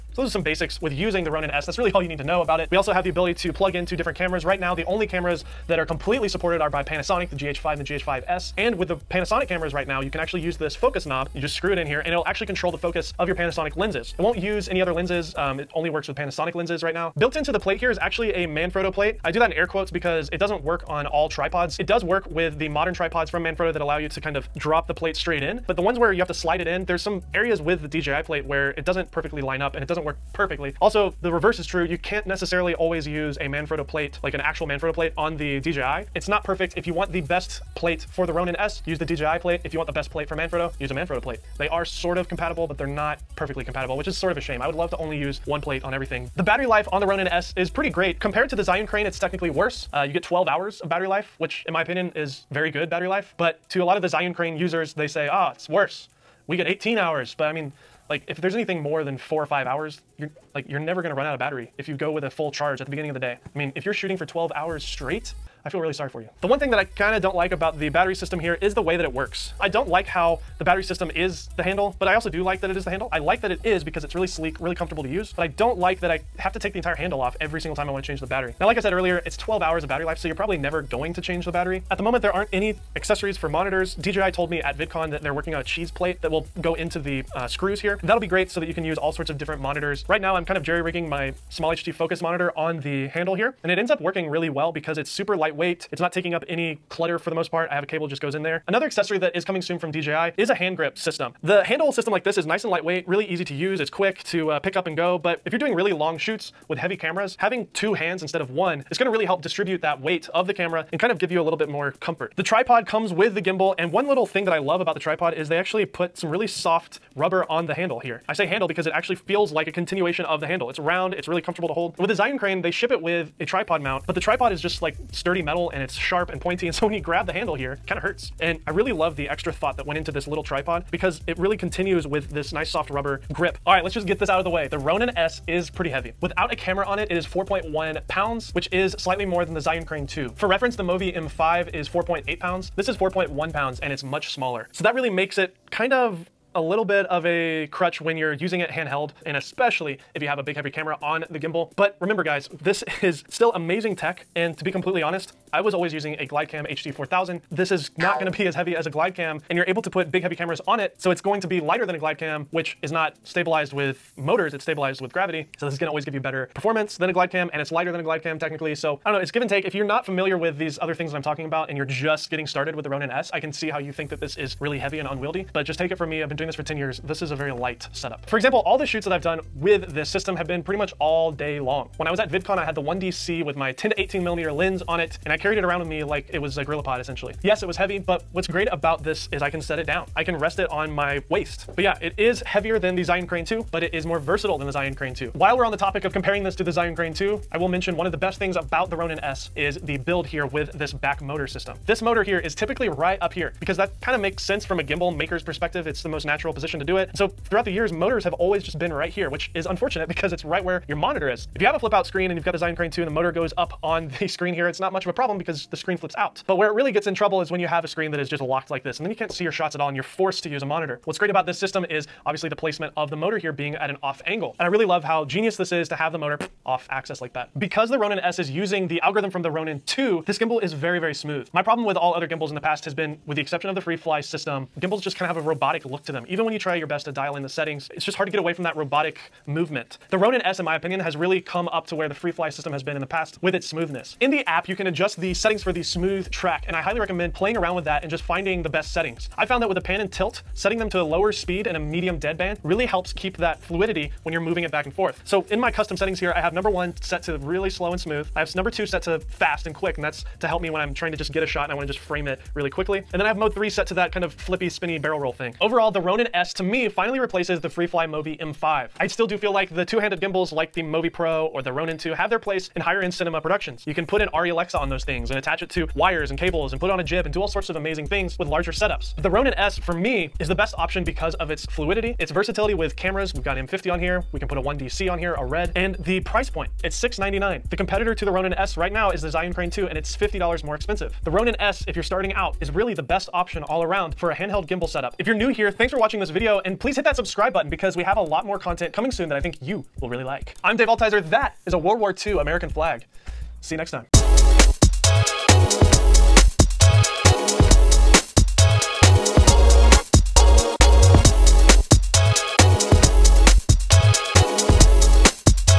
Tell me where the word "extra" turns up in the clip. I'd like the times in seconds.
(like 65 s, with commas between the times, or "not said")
129 s.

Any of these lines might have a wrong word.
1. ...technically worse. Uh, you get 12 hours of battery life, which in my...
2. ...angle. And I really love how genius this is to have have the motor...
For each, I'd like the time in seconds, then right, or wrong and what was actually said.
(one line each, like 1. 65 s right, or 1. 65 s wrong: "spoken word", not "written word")
1. 49 s right
2. 224 s right.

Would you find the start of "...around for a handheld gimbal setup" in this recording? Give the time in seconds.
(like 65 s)
293 s.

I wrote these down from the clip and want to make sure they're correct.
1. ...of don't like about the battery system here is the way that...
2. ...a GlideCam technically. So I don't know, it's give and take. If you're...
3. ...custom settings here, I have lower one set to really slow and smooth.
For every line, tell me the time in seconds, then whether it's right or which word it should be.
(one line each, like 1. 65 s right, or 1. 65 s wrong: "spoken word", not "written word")
1. 67 s right
2. 167 s right
3. 255 s wrong: "number", not "lower".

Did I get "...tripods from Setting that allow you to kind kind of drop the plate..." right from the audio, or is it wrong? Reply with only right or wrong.
wrong.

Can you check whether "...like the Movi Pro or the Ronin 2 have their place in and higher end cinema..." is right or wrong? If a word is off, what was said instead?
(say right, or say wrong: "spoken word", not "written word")
right.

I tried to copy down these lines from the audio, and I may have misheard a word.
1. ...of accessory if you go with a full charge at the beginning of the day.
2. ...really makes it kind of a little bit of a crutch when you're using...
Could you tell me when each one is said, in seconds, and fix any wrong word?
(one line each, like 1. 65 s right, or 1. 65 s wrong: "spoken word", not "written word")
1. 61 s wrong: "battery", not "accessory"
2. 144 s right.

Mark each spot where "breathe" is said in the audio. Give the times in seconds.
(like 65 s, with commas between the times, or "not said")
not said.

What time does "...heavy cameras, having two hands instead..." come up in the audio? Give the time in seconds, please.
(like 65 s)
106 s.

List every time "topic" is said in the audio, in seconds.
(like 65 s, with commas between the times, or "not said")
195 s.